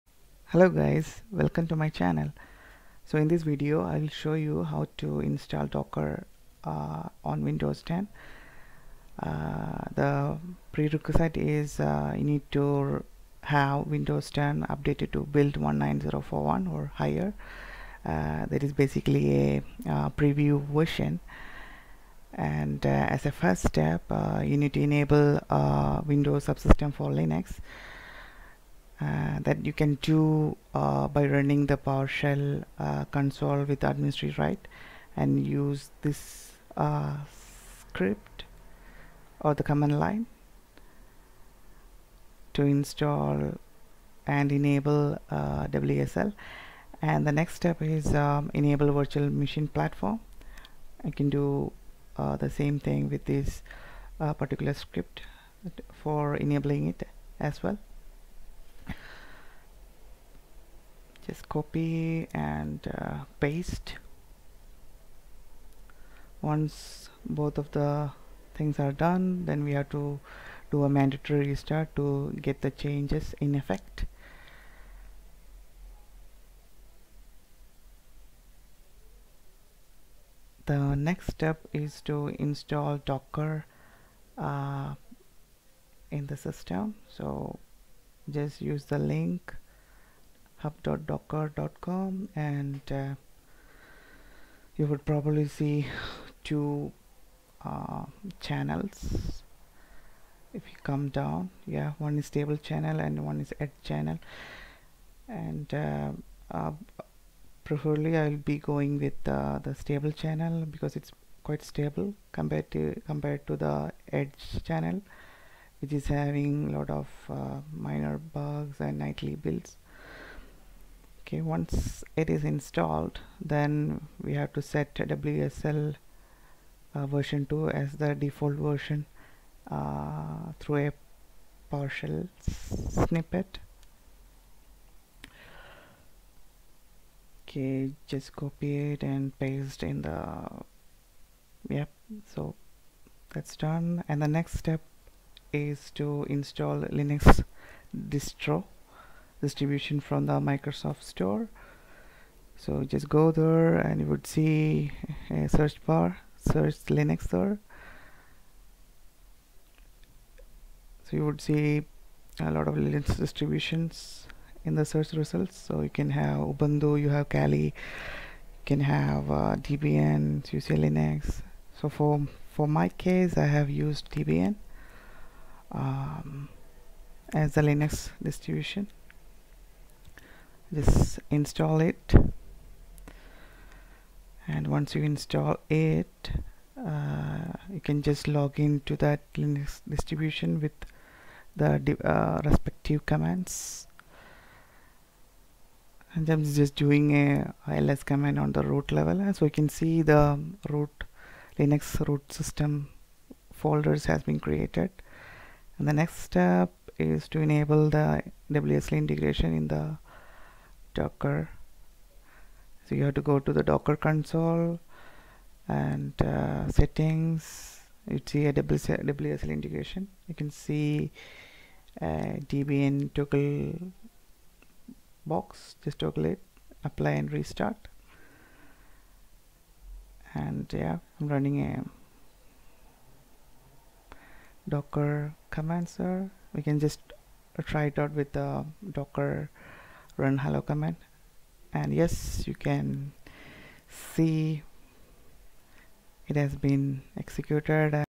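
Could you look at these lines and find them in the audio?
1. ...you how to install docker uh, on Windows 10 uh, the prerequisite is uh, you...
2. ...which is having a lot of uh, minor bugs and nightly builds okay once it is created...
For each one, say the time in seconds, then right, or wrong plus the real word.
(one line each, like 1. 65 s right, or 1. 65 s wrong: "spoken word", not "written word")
1. 4 s right
2. 115 s wrong: "installed", not "created".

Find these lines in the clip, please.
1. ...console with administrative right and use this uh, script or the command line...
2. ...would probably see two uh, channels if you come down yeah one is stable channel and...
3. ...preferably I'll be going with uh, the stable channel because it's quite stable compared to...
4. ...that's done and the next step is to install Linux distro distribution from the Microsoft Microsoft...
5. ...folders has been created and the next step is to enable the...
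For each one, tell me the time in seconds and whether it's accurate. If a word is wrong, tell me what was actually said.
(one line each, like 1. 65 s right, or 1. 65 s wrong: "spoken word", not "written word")
1. 33 s right
2. 94 s right
3. 107 s right
4. 143 s wrong: "Store", not "Microsoft"
5. 203 s right.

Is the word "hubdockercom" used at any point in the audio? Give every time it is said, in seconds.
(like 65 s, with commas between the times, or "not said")
90 s.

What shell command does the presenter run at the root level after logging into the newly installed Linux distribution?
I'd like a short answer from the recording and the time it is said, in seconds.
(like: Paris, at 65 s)
ls, at 197 s.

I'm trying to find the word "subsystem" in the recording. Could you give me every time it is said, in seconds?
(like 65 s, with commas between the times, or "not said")
26 s.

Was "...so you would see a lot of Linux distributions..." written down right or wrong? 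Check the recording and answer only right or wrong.
right.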